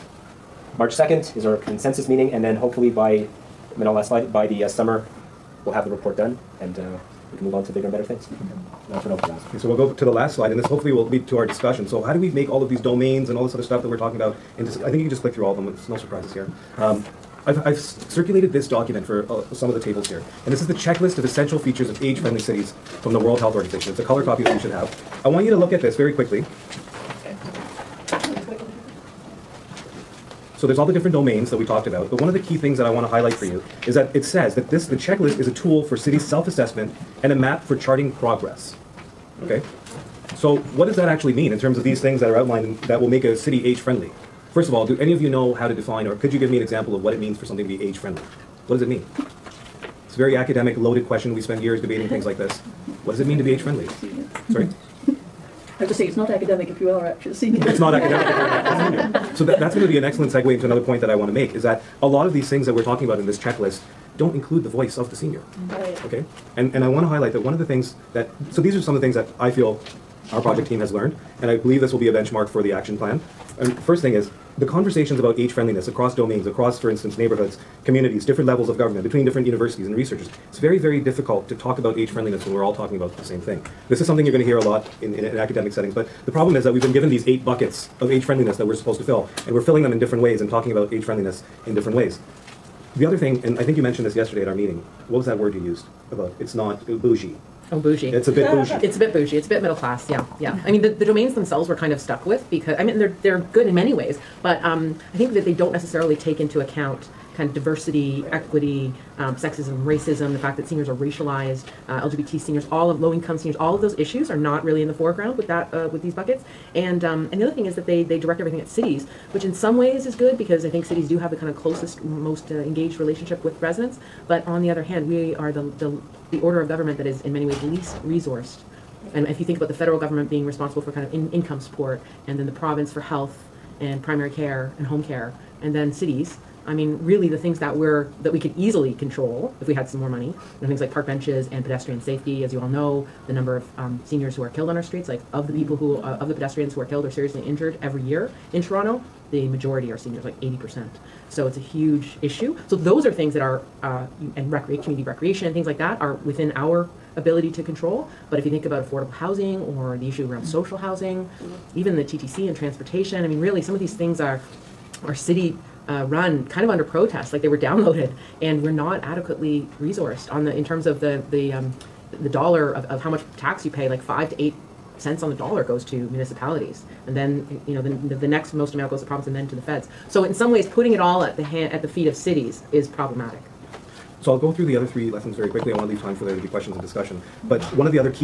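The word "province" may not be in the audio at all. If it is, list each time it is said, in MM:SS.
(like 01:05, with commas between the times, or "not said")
02:12, 02:59.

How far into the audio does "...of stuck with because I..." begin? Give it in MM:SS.
01:41.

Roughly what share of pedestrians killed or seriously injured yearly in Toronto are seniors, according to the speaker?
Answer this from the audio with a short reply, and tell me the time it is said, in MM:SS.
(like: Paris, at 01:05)
80%, at 02:30.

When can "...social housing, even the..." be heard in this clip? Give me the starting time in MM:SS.
02:40.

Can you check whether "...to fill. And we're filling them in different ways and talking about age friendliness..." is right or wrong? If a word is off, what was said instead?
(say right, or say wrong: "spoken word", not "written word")
right.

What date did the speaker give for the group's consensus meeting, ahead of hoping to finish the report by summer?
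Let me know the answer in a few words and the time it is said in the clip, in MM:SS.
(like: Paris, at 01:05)
March 2nd, at 00:00.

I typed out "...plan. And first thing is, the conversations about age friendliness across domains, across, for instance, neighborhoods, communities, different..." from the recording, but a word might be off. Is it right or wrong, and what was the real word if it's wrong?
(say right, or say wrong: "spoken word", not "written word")
right.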